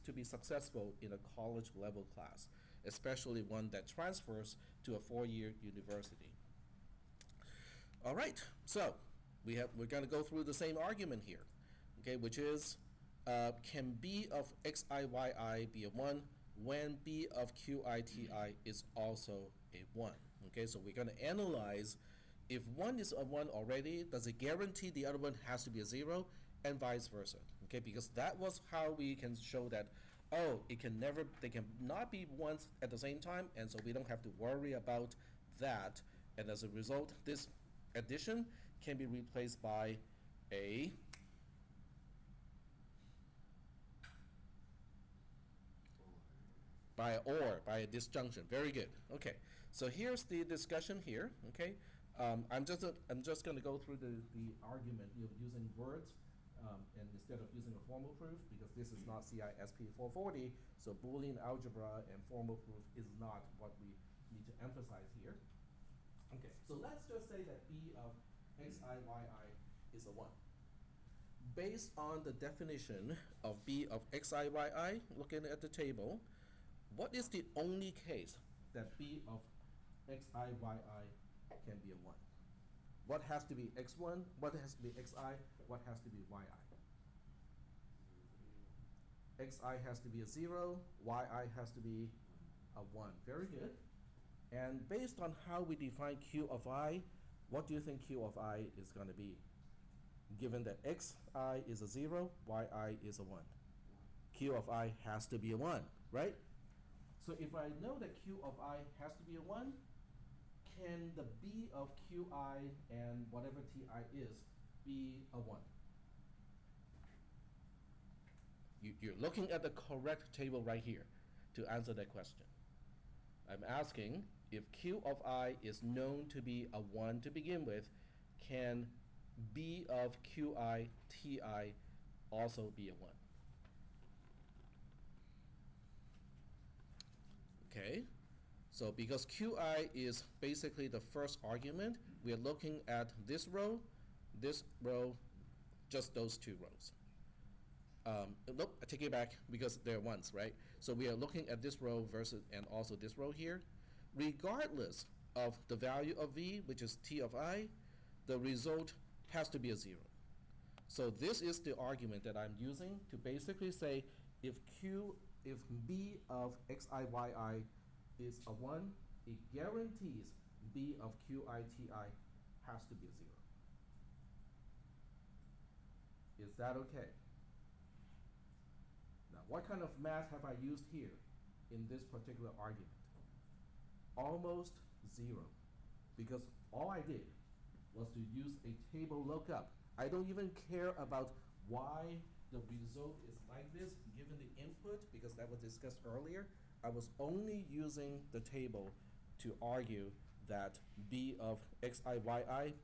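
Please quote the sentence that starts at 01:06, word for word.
Okay, so let's just say that B of x i y i is a 1.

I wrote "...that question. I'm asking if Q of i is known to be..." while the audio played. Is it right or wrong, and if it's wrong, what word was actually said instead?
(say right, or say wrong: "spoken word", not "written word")
right.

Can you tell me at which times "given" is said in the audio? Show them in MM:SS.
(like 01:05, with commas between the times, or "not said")
01:40, 03:14.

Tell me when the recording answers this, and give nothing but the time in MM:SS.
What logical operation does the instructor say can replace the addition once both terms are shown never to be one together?
00:47.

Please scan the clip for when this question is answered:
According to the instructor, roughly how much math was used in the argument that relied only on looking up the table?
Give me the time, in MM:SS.
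03:04.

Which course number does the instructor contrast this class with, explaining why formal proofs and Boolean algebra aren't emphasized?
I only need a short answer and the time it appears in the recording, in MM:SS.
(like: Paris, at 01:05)
CISP 440, at 00:59.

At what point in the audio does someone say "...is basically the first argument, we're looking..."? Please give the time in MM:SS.
02:19.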